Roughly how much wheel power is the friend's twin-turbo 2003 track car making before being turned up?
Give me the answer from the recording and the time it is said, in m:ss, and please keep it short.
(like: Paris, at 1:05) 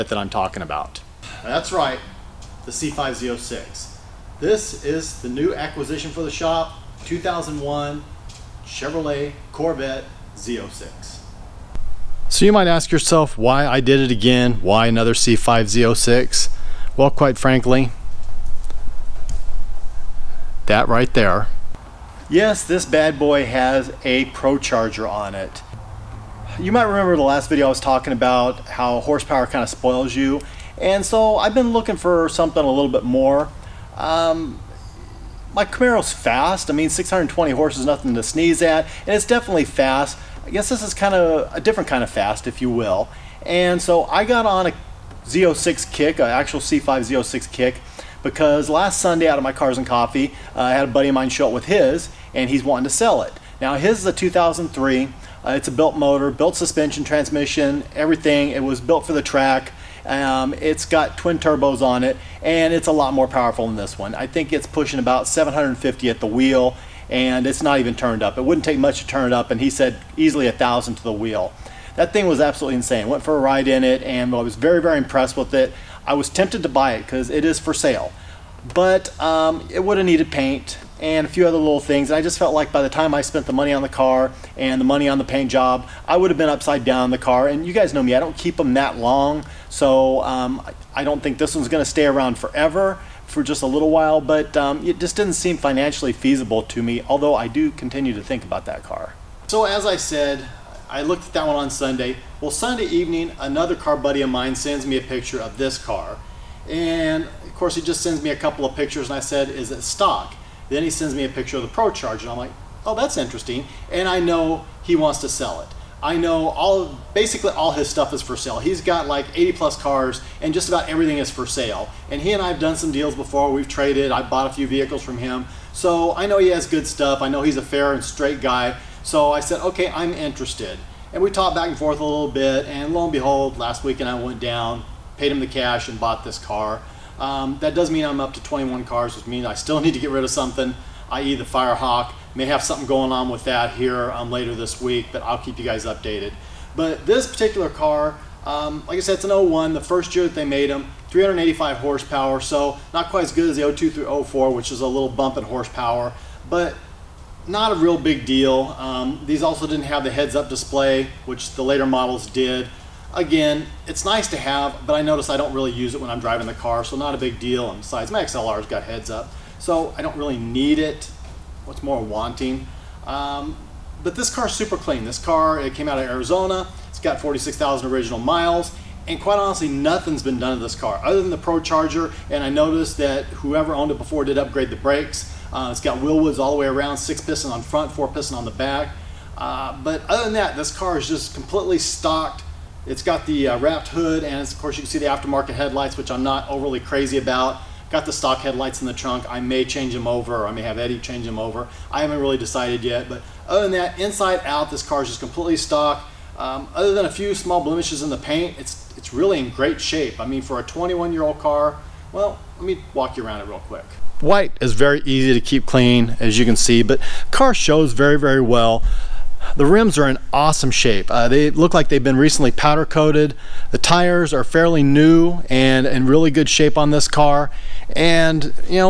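750, at 1:05.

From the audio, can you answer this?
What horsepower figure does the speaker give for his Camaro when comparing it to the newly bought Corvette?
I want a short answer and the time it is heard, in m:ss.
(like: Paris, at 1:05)
620, at 0:36.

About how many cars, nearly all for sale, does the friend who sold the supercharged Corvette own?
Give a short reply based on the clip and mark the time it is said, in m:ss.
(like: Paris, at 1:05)
80 plus, at 1:59.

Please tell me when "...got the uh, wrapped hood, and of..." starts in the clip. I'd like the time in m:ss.
3:13.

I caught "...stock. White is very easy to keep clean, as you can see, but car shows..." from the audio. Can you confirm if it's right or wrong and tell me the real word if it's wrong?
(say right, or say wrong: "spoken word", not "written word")
wrong: "quick", not "stock".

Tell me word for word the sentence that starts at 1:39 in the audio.
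So as I said, I looked at that one on Sunday.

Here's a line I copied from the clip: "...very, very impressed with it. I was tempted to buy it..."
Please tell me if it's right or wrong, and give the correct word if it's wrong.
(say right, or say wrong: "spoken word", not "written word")
right.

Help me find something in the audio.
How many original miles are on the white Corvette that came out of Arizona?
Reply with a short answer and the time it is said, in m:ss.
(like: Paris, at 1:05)
46,000, at 2:57.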